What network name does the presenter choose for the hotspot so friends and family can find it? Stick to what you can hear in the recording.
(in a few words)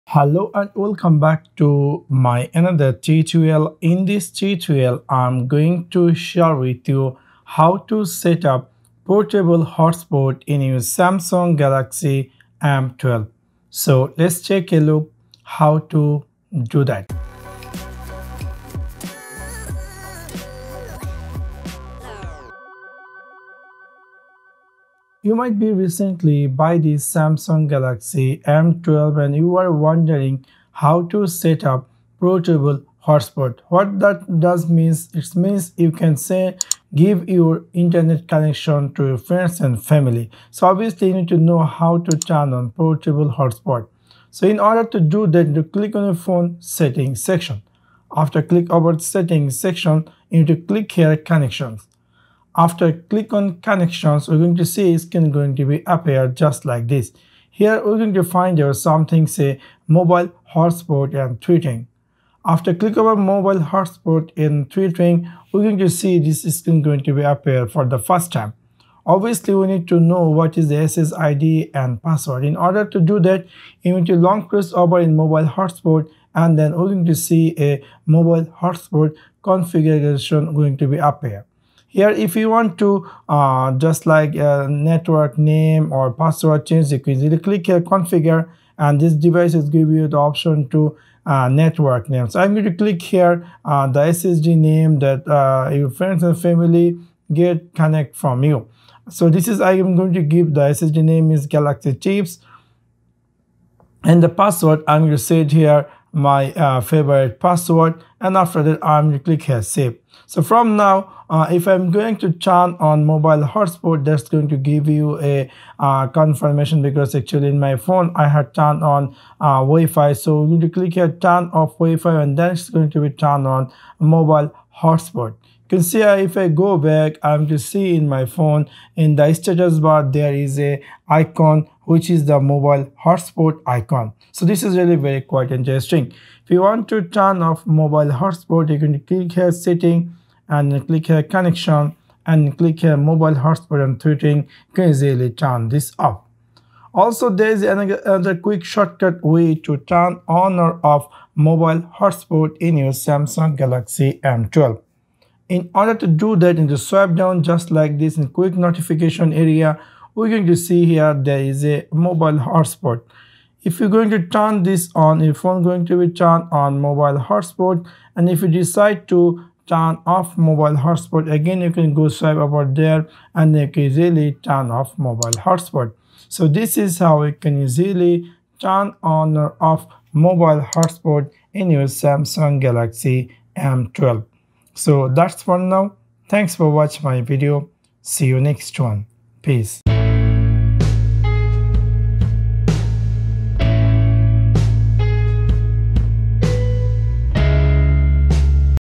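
Galaxy Chips.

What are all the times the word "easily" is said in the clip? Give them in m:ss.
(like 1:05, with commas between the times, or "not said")
1:27, 2:24, 2:57.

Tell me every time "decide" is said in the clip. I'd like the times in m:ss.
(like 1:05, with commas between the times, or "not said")
2:48.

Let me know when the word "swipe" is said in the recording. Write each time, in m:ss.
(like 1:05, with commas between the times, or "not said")
2:36, 2:52.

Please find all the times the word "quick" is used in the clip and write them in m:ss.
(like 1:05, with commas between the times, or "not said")
2:28, 2:38.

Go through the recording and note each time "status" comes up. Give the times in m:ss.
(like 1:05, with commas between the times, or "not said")
2:09.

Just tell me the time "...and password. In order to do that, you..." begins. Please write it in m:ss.
1:11.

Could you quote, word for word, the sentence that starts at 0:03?
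In this tutorial, I'm going to share with you how to set up portable hotspot in your Samsung Galaxy M12.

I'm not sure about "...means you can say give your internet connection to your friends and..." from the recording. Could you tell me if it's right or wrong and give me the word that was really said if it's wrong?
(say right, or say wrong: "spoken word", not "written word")
right.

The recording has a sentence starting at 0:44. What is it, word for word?
So in order to do that, you click on the phone settings section.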